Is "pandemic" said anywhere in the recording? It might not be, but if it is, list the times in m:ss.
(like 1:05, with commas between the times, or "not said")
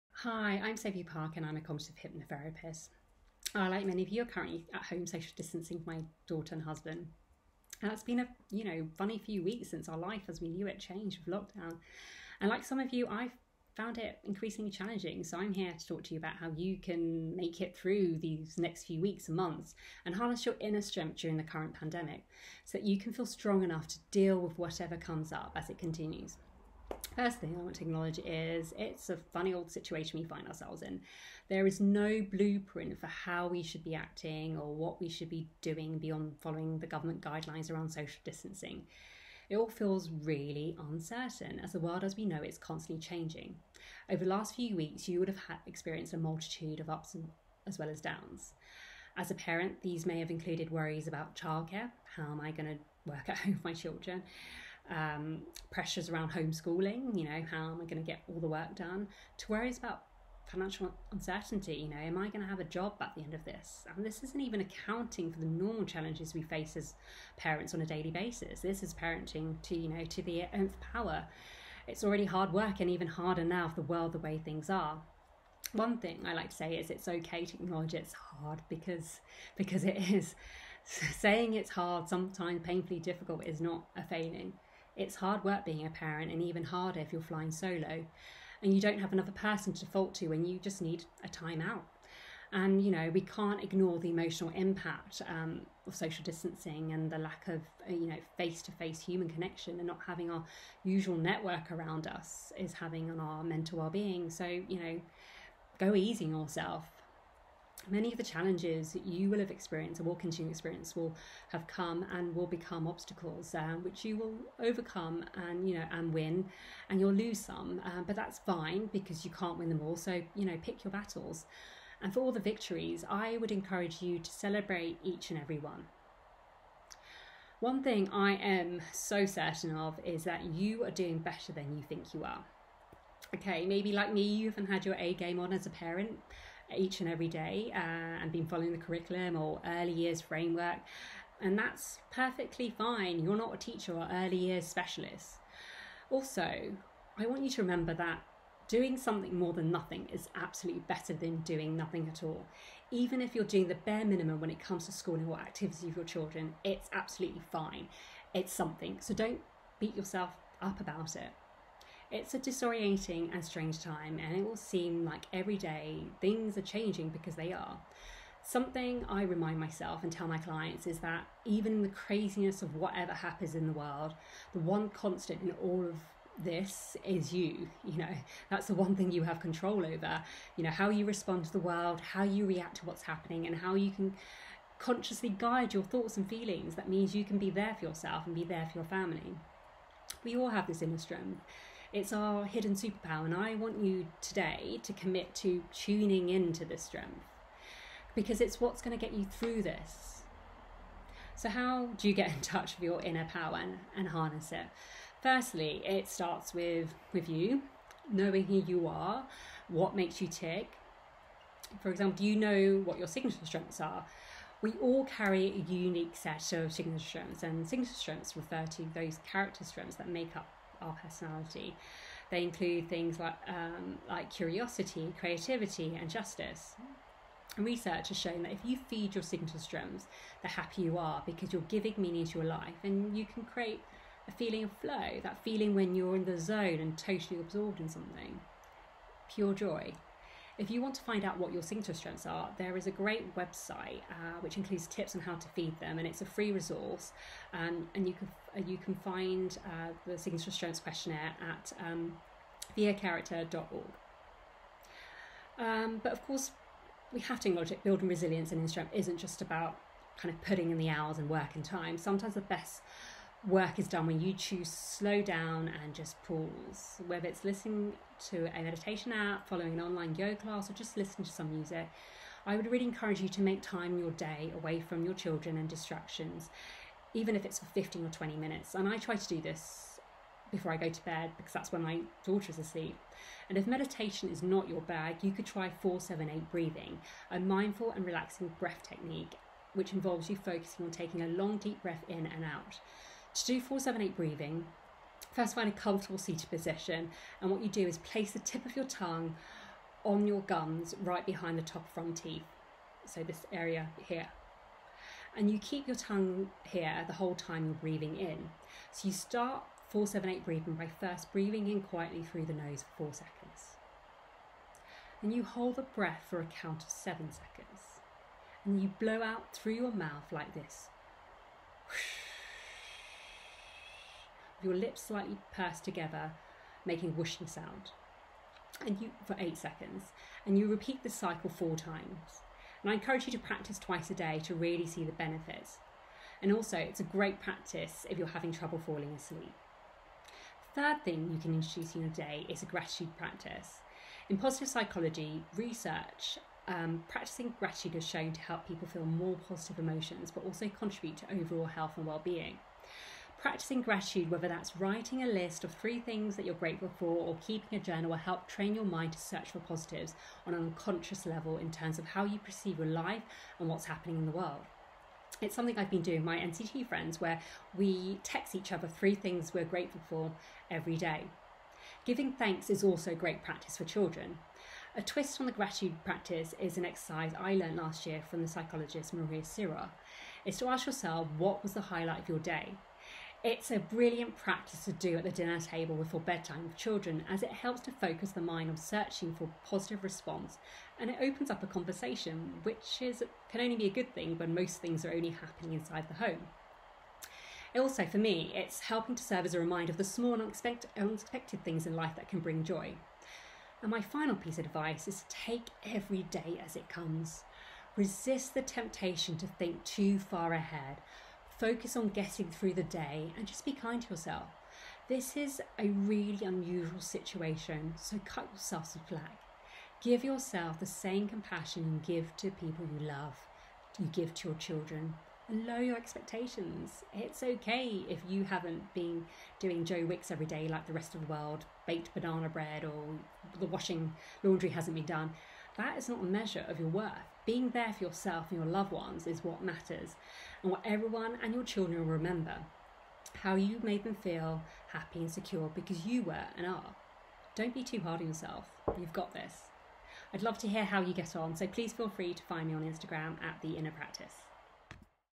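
0:21.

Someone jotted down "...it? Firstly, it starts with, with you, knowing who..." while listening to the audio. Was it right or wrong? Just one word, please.
right.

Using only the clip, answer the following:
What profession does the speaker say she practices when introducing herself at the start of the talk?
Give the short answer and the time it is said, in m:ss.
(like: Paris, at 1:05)
cognitive hypnotherapist, at 0:01.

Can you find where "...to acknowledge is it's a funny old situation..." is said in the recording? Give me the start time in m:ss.
0:27.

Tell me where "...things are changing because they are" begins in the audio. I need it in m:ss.
2:46.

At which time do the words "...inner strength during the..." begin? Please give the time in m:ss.
0:20.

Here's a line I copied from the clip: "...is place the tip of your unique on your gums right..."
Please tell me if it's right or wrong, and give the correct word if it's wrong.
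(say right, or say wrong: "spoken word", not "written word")
wrong: "tongue", not "unique".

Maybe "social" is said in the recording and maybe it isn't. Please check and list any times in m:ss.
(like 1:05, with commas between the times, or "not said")
0:05, 0:37, 1:35.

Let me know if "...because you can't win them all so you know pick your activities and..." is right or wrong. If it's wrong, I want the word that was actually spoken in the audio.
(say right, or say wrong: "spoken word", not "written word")
wrong: "battles", not "activities".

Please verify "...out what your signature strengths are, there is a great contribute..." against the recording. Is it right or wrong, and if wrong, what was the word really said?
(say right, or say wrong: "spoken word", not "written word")
wrong: "website", not "contribute".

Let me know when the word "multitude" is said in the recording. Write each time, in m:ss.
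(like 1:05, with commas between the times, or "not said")
0:46.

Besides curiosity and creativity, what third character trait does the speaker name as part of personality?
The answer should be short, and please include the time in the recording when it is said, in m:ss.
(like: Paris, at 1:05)
justice, at 3:46.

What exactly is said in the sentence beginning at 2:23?
You're not a teacher or early years specialist.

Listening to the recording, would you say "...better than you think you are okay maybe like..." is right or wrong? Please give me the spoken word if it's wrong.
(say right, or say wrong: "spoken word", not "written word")
right.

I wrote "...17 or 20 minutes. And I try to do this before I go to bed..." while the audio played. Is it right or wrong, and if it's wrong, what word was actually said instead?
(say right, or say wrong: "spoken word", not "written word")
wrong: "15", not "17".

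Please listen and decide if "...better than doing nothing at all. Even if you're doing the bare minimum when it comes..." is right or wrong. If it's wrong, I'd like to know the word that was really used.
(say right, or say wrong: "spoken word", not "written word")
right.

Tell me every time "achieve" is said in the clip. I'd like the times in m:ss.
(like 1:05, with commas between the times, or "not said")
not said.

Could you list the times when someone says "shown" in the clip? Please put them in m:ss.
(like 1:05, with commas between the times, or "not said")
3:48, 5:48.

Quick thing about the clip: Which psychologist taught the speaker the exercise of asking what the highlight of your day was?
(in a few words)
Maria Sirois.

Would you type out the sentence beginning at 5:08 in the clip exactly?
So, you start 478 breathing by first breathing in quietly through the nose for four seconds.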